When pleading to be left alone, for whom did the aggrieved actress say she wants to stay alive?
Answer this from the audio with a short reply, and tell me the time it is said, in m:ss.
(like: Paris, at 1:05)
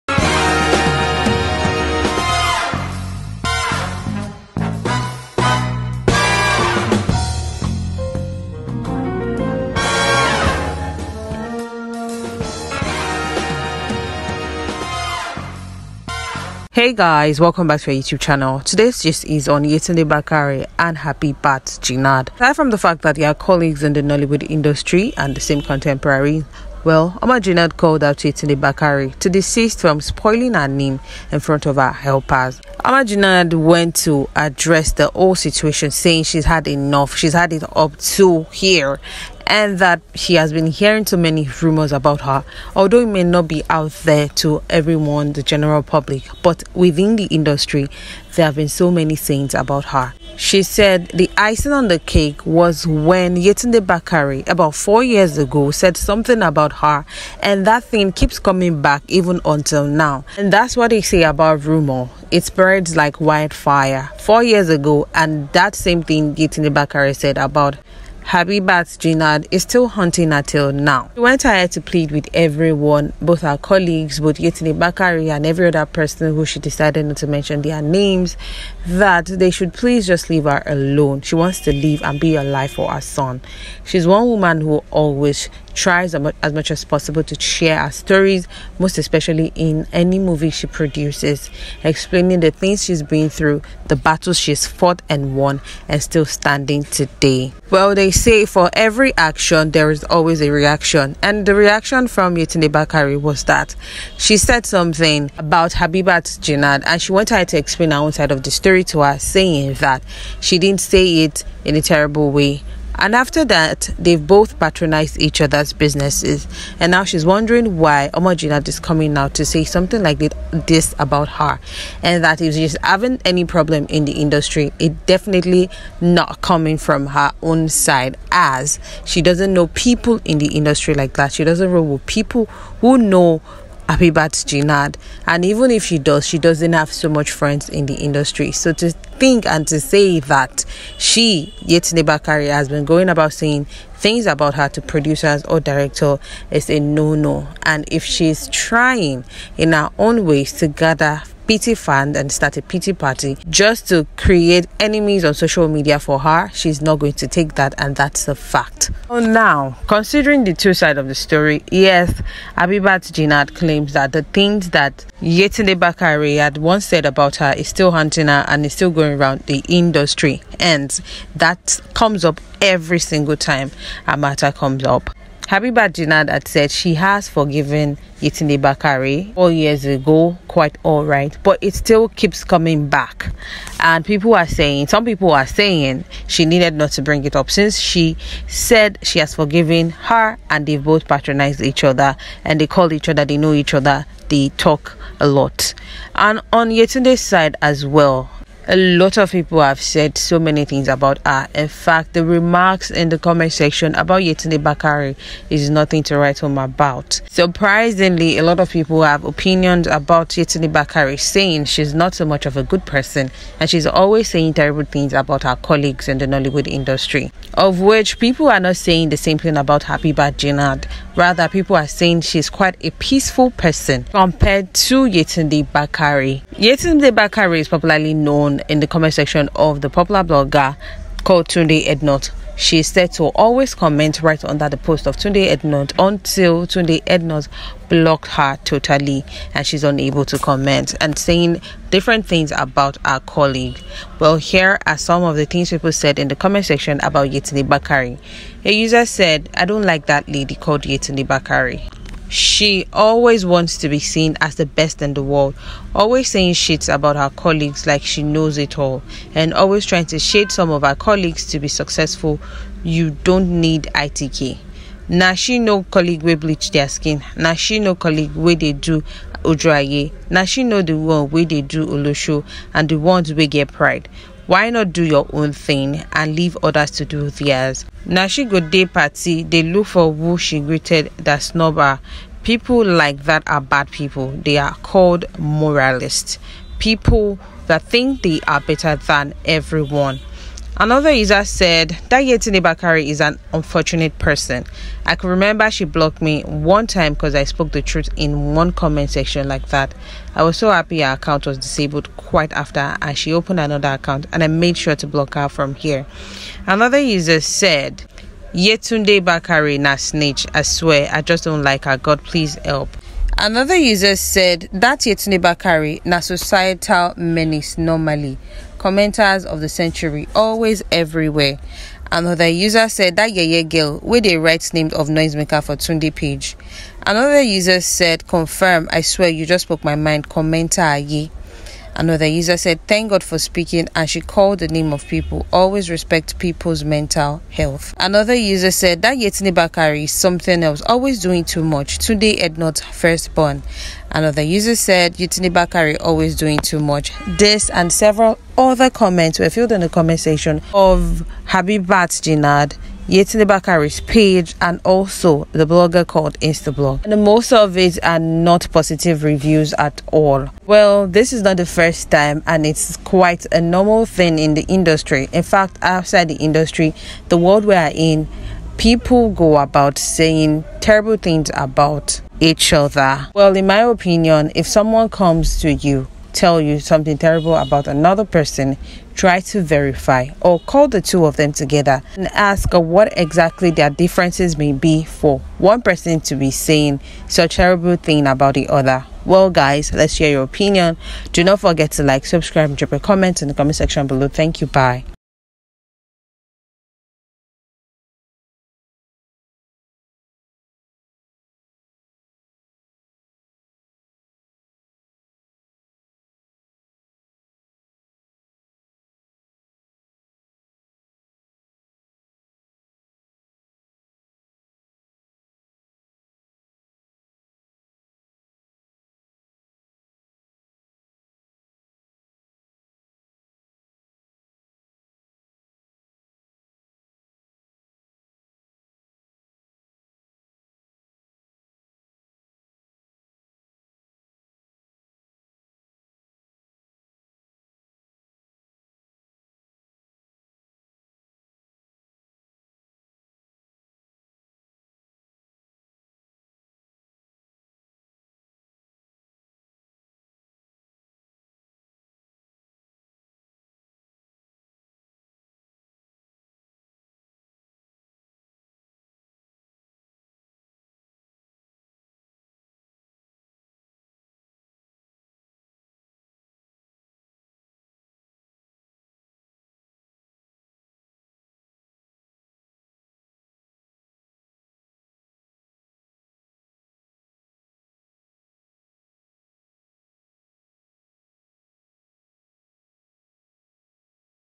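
her son, at 1:22.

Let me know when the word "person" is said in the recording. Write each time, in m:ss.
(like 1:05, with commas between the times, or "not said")
1:15, 3:32, 3:43, 4:54, 6:18, 6:25.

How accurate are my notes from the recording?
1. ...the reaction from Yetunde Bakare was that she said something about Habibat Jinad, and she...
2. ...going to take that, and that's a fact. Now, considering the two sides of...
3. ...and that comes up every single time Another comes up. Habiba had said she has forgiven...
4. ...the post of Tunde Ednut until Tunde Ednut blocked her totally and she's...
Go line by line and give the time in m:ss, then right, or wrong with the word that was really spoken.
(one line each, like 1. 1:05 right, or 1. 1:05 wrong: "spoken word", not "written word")
1. 1:41 right
2. 2:36 right
3. 2:50 wrong: "Amata", not "Another"
4. 3:54 right.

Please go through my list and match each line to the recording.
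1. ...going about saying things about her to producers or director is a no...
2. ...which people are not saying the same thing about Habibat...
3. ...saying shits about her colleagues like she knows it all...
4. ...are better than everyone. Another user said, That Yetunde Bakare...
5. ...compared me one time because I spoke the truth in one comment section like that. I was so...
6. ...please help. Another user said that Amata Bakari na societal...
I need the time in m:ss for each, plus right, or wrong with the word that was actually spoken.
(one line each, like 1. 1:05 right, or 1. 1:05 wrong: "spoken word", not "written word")
1. 2:22 right
2. 3:37 right
3. 4:16 right
4. 4:48 right
5. 4:55 wrong: "blocked", not "compared"
6. 5:12 wrong: "Yetunde", not "Amata".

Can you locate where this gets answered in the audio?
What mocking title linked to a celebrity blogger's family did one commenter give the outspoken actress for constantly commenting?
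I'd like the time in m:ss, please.
5:42.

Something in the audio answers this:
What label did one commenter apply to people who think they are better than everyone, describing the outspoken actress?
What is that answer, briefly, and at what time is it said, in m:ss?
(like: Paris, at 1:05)
moralists, at 4:45.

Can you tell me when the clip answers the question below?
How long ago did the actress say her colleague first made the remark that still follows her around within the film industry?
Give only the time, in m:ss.
0:54.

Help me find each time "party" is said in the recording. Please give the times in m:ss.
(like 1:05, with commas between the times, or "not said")
2:32, 4:38.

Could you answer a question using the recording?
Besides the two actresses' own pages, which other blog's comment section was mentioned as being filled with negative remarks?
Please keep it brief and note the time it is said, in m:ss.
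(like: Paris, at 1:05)
Instablog, at 5:56.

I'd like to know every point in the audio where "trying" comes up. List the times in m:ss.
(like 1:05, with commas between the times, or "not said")
2:28, 4:19.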